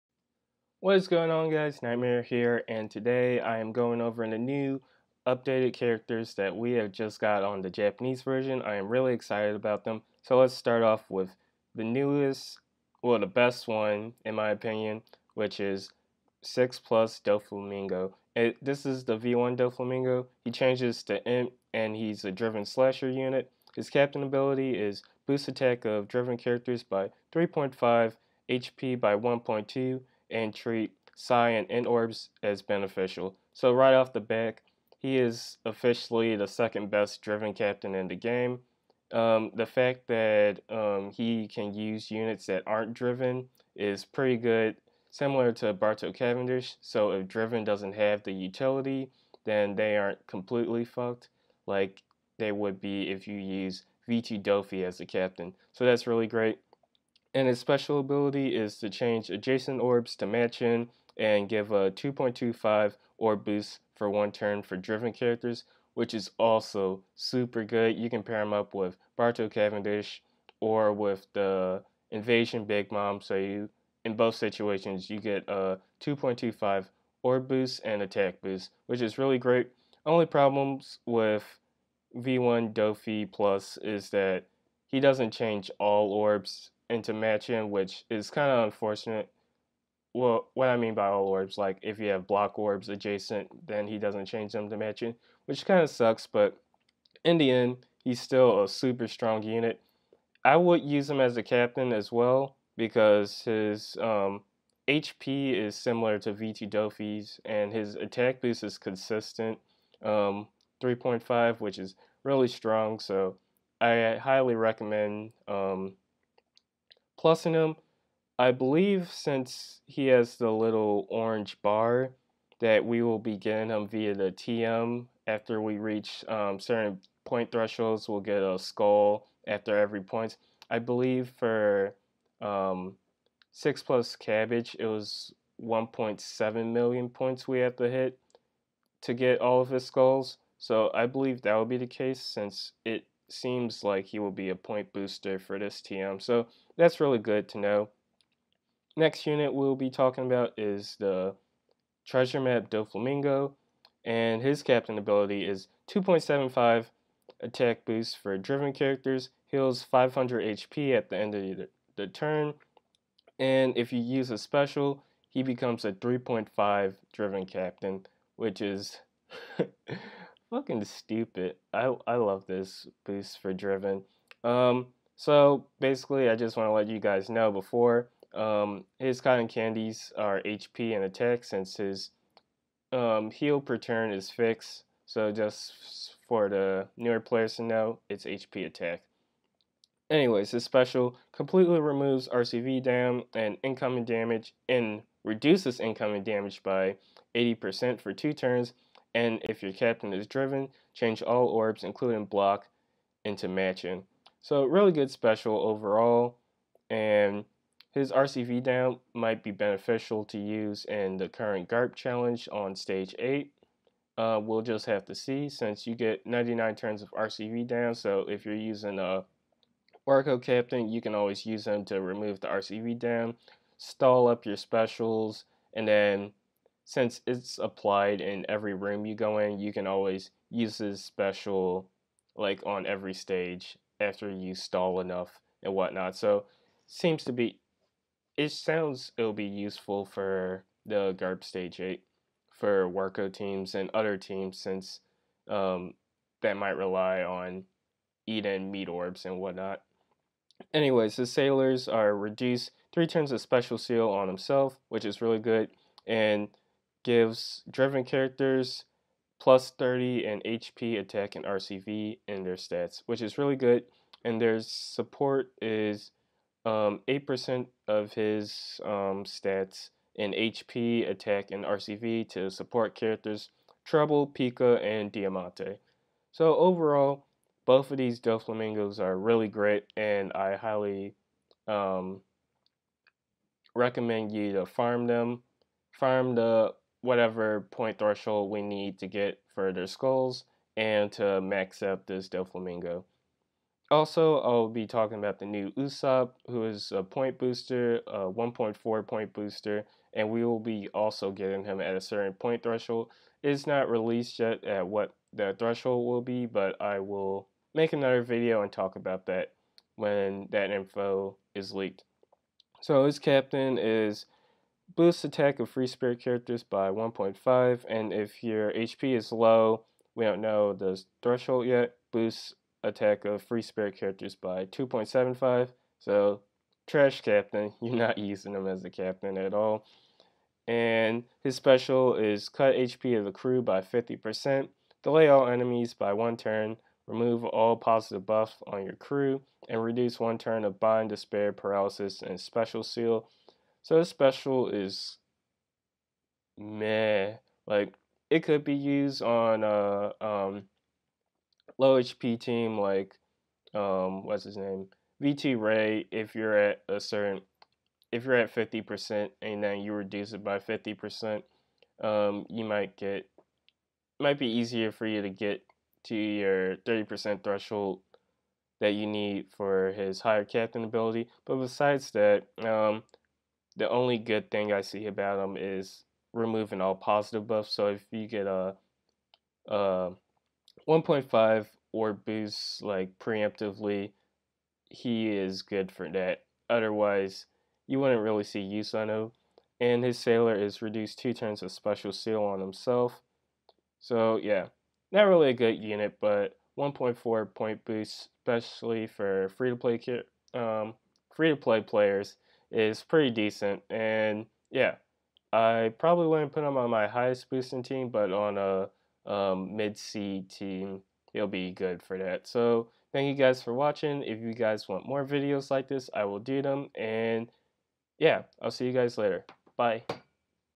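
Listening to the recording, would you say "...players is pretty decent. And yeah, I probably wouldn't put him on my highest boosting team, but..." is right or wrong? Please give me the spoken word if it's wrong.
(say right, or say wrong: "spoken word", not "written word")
right.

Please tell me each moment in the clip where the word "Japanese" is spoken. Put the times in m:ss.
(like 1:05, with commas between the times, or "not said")
0:07.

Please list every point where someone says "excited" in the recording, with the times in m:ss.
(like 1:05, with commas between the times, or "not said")
0:09.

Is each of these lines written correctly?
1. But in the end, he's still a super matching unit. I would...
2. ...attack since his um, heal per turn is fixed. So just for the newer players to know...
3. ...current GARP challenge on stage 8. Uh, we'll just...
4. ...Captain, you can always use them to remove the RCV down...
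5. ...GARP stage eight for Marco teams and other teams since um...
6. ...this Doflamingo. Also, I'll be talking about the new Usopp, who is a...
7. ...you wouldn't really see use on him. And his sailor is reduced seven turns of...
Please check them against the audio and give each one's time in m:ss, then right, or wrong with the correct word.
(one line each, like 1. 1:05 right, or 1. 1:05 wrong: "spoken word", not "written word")
1. 1:36 wrong: "strong", not "matching"
2. 3:01 right
3. 3:31 right
4. 3:40 right
5. 4:01 right
6. 4:52 right
7. 6:27 wrong: "two", not "seven".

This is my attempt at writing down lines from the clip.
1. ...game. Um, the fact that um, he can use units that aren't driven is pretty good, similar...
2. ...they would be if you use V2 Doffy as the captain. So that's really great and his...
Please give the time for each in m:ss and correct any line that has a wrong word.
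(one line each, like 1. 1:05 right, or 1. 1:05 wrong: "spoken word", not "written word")
1. 0:38 right
2. 0:52 right.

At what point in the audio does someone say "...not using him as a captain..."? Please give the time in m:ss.
5:27.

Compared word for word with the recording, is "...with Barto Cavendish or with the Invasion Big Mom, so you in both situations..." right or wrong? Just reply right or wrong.
right.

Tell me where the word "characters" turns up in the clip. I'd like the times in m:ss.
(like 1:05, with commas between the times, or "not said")
0:05, 0:26, 1:05, 2:38, 4:18, 4:32, 5:16, 5:23.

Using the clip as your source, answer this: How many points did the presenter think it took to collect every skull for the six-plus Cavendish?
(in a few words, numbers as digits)
1.7 million.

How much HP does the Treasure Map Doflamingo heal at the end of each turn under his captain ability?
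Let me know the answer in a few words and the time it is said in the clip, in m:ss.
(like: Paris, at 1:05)
500, at 2:39.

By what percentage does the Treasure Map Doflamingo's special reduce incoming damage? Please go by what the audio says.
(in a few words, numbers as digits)
80%.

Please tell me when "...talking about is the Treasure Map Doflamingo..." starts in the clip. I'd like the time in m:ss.
2:29.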